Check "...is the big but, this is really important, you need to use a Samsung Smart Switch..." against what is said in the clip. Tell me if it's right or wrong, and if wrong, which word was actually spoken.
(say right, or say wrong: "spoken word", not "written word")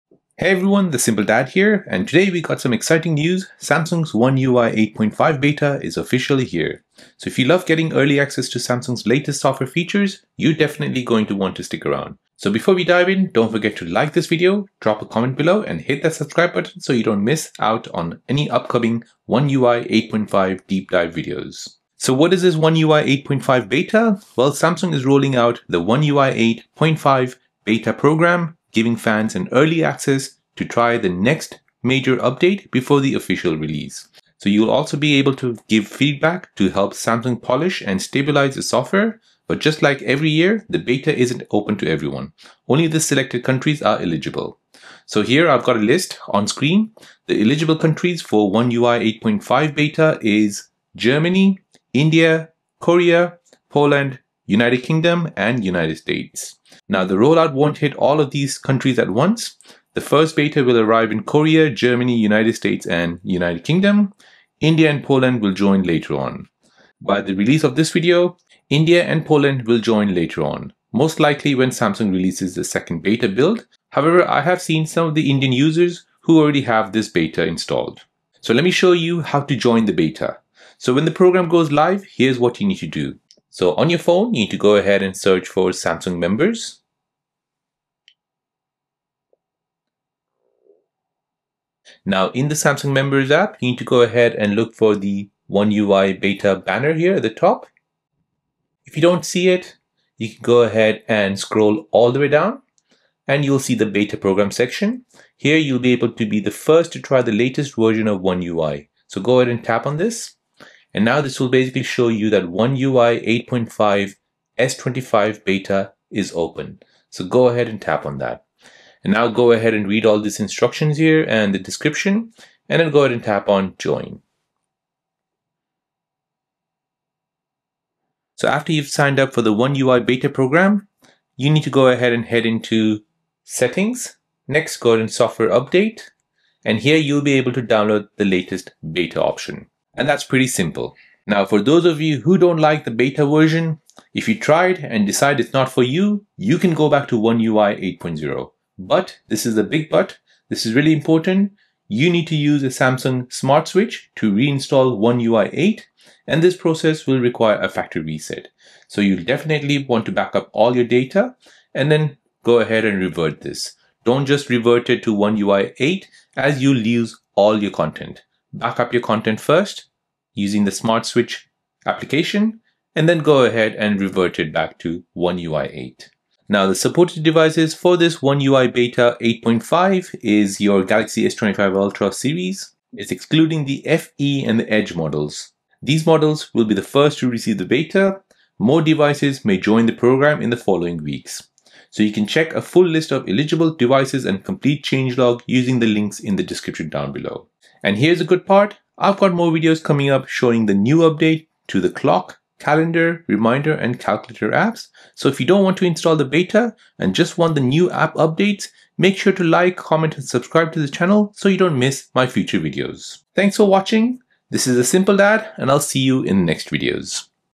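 right.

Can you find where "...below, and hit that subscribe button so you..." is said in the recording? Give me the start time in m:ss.
0:15.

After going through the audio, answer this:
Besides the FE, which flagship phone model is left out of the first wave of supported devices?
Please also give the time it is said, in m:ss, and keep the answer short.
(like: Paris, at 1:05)
Edge, at 3:04.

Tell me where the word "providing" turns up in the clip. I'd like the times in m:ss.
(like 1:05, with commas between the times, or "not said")
not said.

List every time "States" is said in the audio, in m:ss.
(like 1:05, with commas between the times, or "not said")
0:55, 1:02.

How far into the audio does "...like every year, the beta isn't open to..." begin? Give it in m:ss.
0:39.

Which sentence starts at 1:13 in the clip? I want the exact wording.
However, I have seen some of the Indian users who already have this beta installed.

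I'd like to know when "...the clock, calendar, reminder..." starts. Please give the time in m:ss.
3:21.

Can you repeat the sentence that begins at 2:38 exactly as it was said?
So you'll definitely want to back up all your data and then go ahead and revert this.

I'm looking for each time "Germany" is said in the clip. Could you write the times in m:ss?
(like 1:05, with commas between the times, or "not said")
0:50, 1:01.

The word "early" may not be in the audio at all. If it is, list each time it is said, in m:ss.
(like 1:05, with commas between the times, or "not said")
0:07, 0:29.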